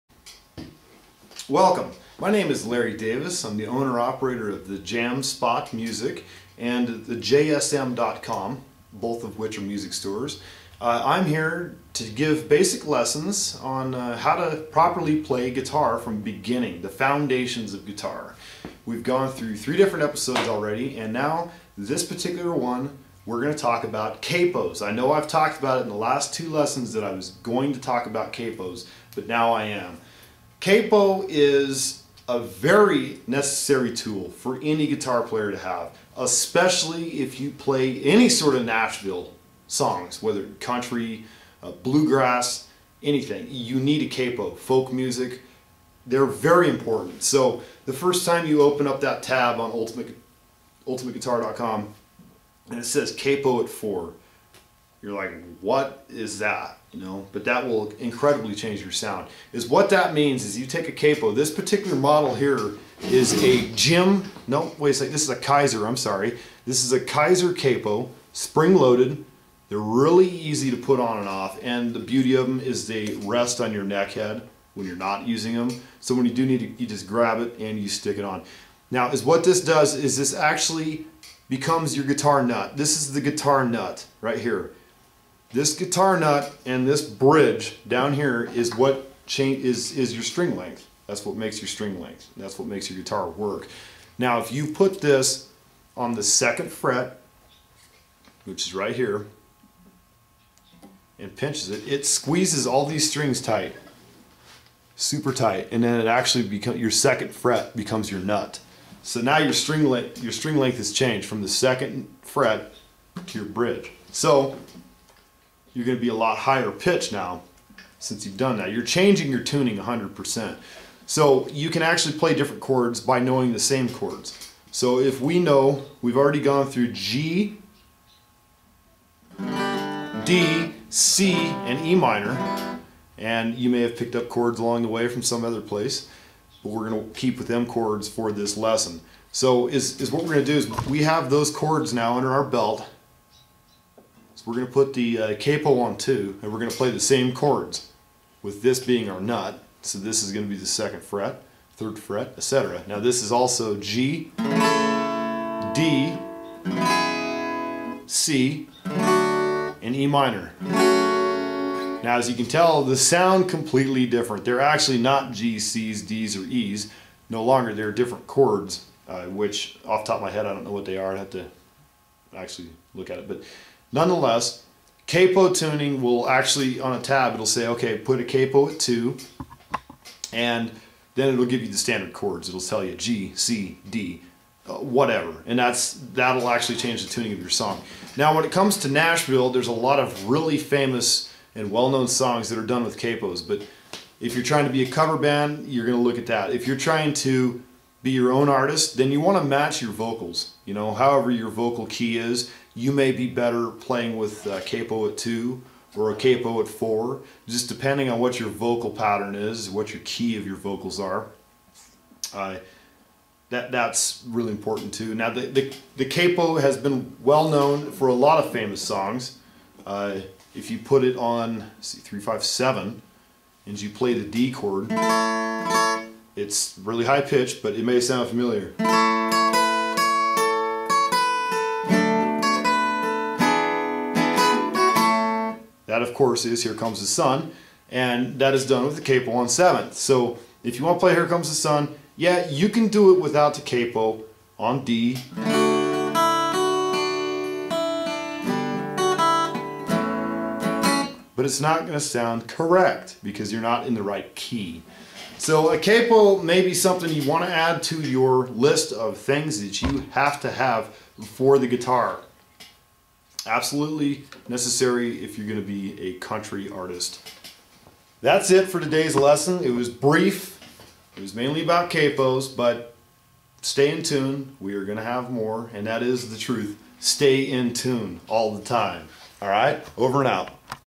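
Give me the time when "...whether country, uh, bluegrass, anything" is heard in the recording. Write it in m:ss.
0:40.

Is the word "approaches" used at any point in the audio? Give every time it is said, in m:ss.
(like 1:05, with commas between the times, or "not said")
not said.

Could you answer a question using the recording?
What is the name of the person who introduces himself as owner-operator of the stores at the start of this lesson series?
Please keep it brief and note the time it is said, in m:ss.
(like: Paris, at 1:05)
Larry Davis, at 0:02.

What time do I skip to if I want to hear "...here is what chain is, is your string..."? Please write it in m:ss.
1:28.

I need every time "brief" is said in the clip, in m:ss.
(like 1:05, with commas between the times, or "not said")
4:29.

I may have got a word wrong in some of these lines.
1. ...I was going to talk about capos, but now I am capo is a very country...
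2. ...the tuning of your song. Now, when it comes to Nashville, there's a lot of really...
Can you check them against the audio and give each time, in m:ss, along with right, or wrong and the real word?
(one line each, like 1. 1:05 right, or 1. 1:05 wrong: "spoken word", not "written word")
1. 0:27 wrong: "necessary", not "country"
2. 3:07 right.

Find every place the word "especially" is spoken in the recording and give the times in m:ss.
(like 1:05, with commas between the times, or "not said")
0:36.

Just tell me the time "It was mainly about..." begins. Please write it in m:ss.
4:31.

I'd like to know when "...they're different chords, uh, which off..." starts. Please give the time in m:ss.
2:47.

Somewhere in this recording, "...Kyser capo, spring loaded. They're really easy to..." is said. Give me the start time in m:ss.
1:06.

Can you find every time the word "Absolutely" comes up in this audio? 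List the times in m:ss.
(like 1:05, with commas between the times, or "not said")
4:23.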